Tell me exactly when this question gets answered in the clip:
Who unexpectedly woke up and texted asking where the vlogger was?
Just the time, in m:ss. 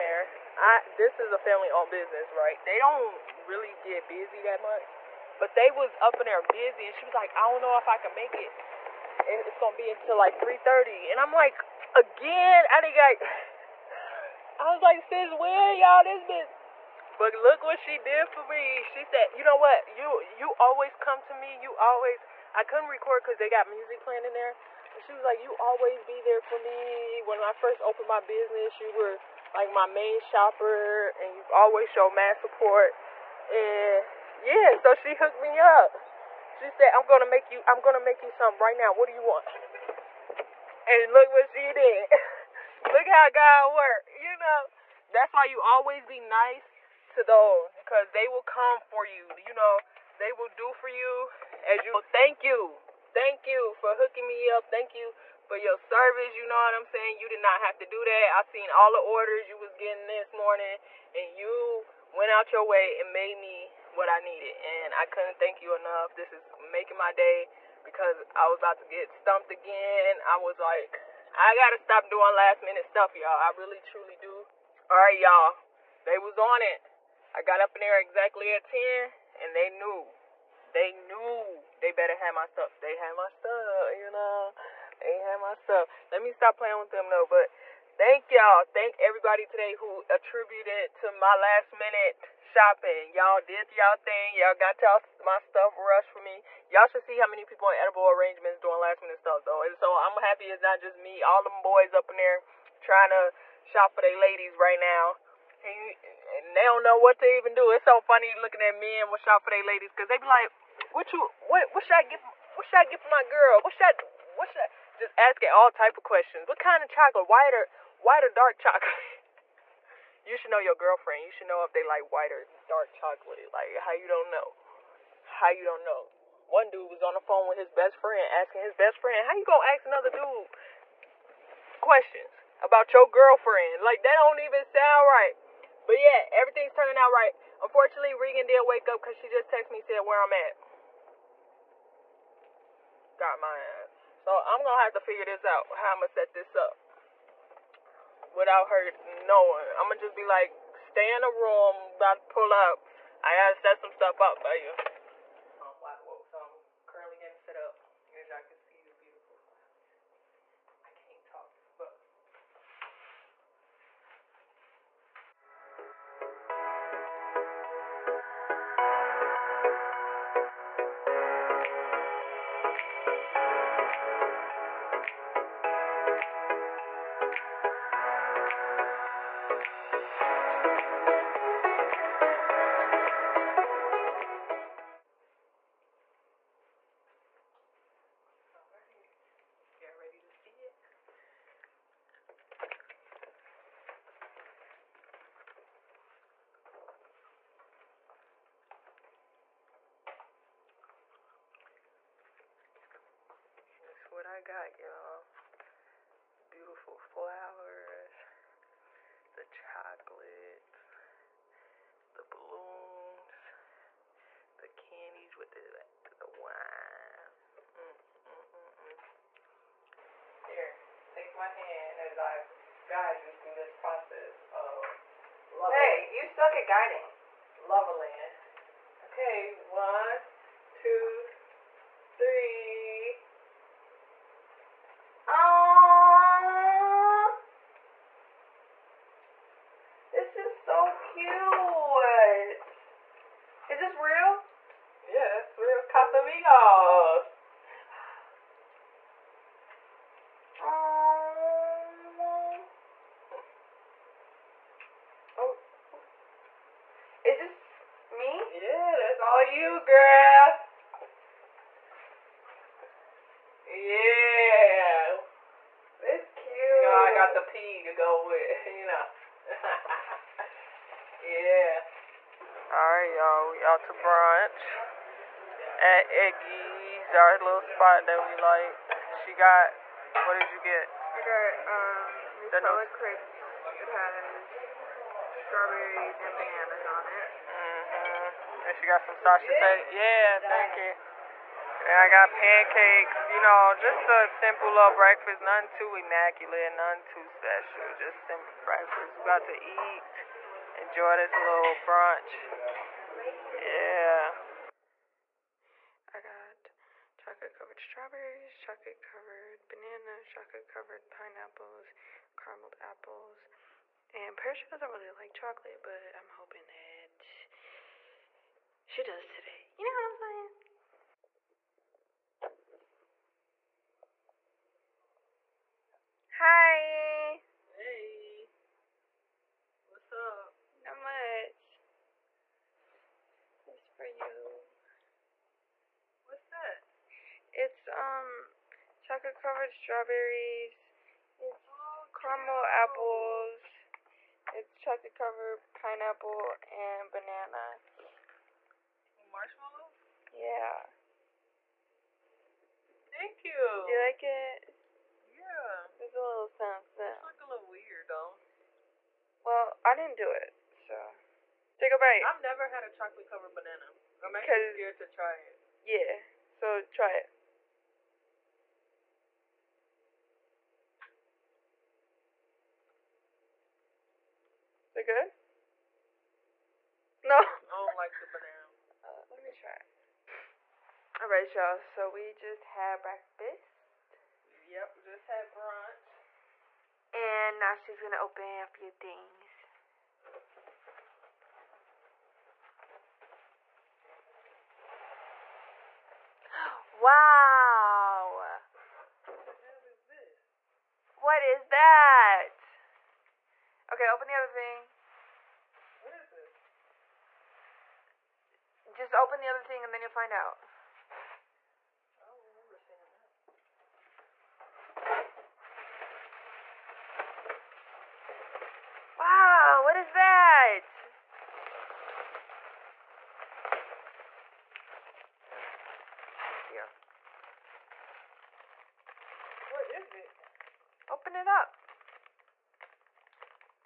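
2:18.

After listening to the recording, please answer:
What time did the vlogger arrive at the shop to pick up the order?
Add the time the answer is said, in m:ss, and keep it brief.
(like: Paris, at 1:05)
10, at 1:18.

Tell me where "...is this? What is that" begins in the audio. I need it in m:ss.
6:39.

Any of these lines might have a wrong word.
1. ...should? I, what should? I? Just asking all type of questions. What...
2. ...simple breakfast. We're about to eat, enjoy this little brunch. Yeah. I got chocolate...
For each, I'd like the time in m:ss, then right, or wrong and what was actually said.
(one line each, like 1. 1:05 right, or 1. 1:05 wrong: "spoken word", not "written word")
1. 1:53 right
2. 4:58 right.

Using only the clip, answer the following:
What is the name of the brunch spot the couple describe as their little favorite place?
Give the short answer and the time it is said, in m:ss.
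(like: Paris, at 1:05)
Eggy's, at 4:36.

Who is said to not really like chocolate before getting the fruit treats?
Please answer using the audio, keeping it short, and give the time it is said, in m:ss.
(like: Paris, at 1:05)
Paris, at 5:14.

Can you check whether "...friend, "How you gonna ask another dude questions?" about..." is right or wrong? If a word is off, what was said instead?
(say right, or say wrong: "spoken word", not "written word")
right.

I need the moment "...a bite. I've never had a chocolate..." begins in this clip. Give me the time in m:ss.
6:01.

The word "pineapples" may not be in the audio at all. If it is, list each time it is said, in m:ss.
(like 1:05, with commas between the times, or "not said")
5:11, 5:45.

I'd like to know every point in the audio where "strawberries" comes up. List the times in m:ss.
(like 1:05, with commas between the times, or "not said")
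4:45, 5:07, 5:39.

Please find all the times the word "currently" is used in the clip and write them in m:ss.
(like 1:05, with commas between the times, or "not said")
2:36.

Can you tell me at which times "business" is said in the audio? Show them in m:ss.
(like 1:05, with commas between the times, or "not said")
0:01, 0:28.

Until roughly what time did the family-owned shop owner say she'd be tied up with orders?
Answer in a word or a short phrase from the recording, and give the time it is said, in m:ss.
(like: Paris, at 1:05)
3:30, at 0:10.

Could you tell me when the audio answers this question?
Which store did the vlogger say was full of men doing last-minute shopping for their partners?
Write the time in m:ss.
1:37.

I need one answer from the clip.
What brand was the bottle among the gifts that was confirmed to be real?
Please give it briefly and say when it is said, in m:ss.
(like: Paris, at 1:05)
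Casamigos, at 4:05.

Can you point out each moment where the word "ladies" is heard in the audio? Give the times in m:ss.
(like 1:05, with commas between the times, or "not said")
1:44, 1:49.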